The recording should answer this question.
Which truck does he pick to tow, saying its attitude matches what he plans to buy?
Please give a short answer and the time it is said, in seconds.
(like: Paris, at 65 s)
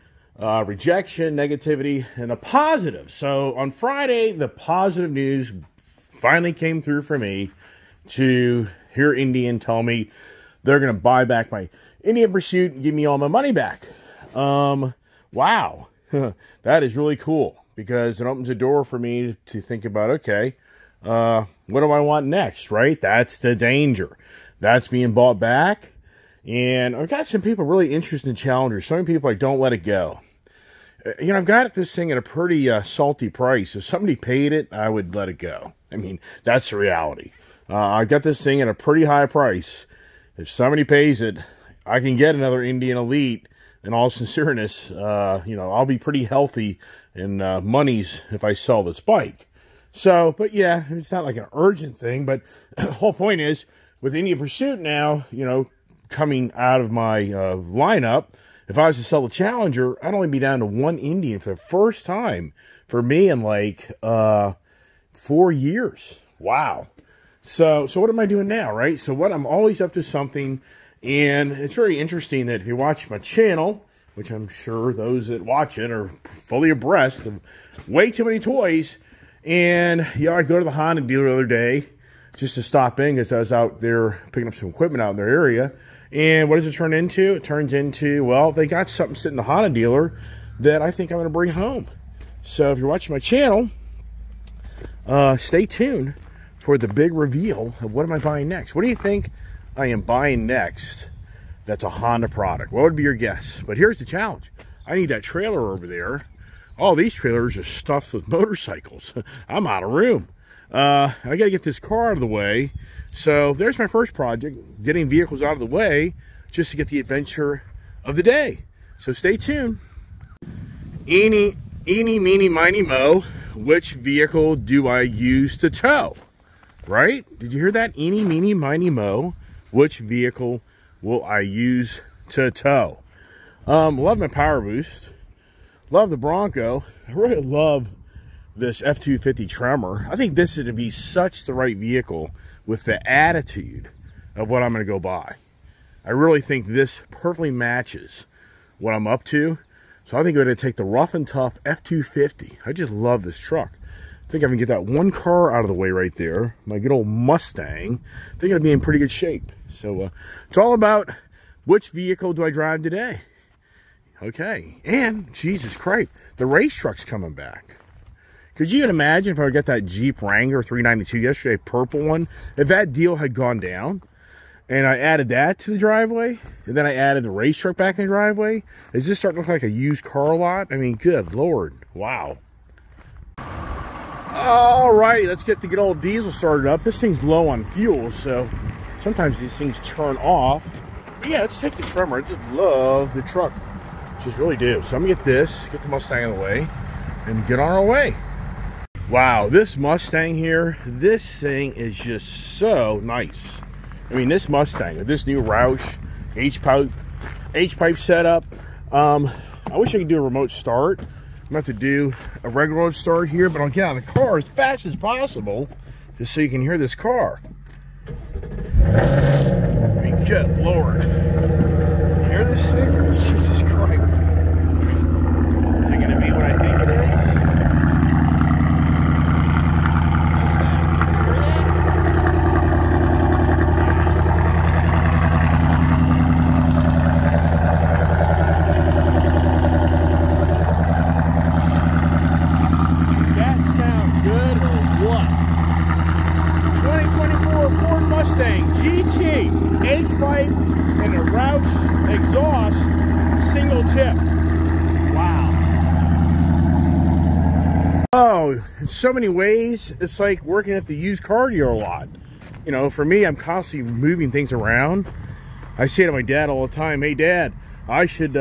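F-250 Tremor, at 138 s.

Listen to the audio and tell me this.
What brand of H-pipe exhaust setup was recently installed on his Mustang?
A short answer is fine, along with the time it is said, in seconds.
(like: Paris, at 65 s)
Roush, at 205 s.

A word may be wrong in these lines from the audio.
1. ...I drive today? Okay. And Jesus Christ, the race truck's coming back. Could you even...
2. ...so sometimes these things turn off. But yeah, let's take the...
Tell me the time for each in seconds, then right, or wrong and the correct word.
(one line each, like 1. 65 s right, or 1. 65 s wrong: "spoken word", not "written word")
1. 162 s right
2. 188 s right.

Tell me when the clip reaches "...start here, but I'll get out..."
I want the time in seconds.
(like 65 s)
212 s.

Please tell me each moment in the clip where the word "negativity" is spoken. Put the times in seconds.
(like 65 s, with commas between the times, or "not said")
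1 s.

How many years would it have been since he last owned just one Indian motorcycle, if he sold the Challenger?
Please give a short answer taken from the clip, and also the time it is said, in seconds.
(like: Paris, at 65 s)
4, at 65 s.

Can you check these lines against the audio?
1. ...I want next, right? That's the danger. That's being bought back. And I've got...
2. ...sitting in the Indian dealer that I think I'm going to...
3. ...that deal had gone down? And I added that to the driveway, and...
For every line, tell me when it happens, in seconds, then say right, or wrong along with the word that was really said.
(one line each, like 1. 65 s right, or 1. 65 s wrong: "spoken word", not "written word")
1. 21 s right
2. 89 s wrong: "Honda", not "Indian"
3. 172 s right.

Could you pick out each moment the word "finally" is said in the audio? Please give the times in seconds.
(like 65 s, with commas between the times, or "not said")
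6 s.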